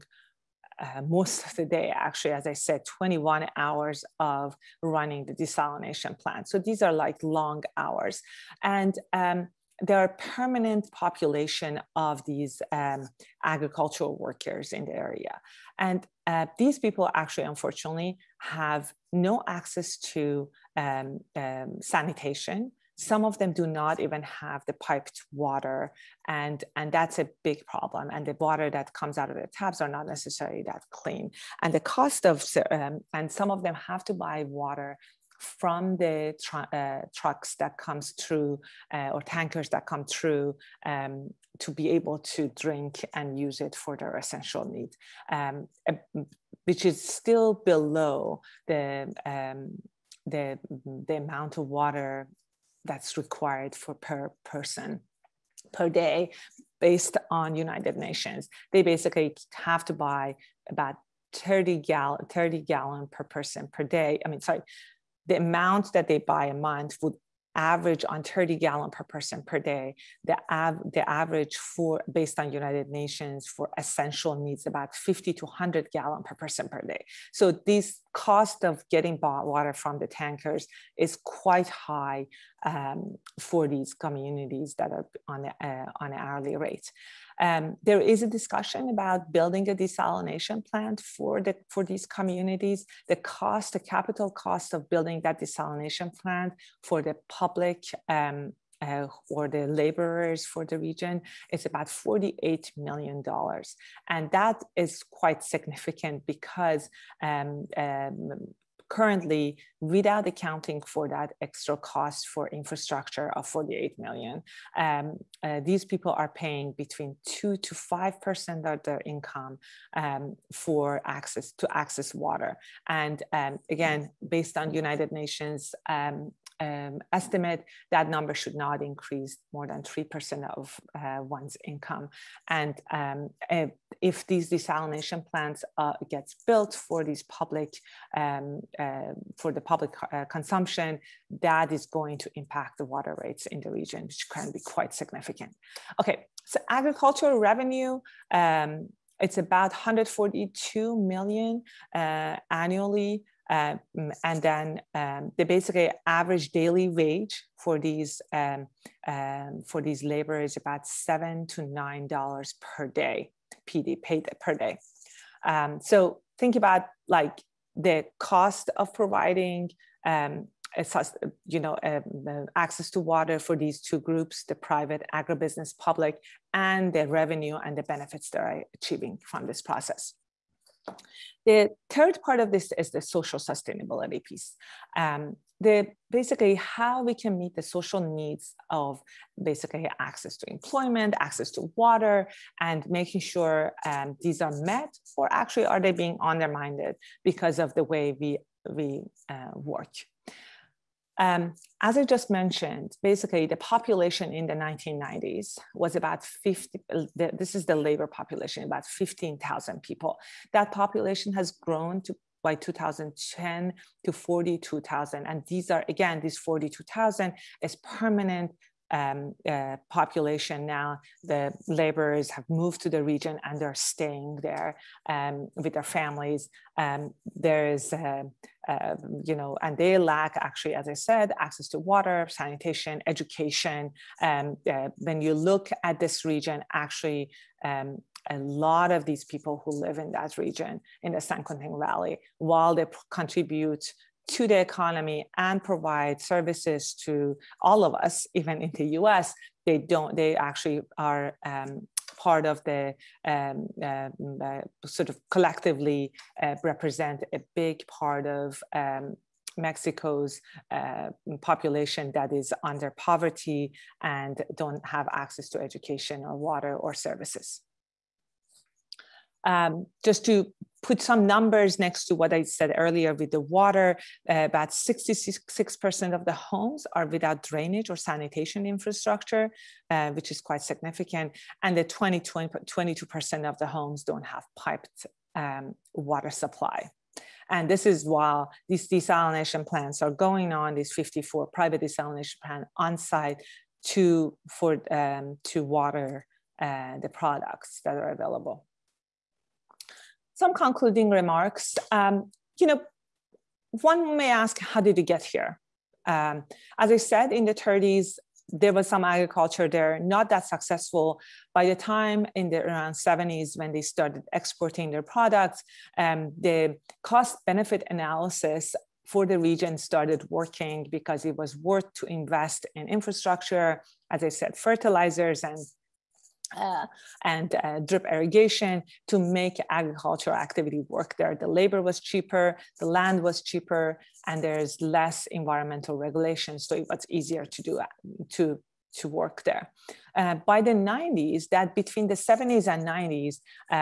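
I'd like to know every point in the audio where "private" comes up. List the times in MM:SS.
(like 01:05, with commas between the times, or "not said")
02:54, 04:51.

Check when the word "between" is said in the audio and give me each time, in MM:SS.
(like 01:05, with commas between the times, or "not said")
01:56, 05:41.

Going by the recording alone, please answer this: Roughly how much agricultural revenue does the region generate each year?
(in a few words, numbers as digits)
142 million.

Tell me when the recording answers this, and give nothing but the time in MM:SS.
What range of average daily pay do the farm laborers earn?
02:40.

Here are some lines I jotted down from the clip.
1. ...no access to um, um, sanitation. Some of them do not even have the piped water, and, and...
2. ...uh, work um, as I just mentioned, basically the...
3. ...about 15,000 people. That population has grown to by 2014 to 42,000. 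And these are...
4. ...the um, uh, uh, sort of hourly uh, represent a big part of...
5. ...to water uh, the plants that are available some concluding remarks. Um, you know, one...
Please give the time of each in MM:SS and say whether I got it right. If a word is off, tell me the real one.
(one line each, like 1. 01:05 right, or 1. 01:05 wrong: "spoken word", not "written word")
1. 00:19 right
2. 03:19 right
3. 03:28 wrong: "2010", not "2014"
4. 04:12 wrong: "collectively", not "hourly"
5. 04:55 wrong: "products", not "plants".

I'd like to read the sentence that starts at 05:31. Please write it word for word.
The labor was cheaper, the land was cheaper, and there's less environmental regulation.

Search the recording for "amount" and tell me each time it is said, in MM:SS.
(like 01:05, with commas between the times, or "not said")
00:51, 01:05.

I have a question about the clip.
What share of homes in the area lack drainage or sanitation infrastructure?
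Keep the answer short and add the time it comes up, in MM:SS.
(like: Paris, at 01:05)
66%, at 04:34.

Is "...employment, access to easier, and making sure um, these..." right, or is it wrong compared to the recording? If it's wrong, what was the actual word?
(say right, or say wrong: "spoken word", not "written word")
wrong: "water", not "easier".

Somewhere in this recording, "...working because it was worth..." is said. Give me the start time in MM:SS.
05:20.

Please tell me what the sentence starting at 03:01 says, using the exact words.
The third part of this is the social sustainability piece.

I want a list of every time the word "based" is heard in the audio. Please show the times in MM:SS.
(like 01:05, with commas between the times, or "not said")
00:56, 01:12, 02:04.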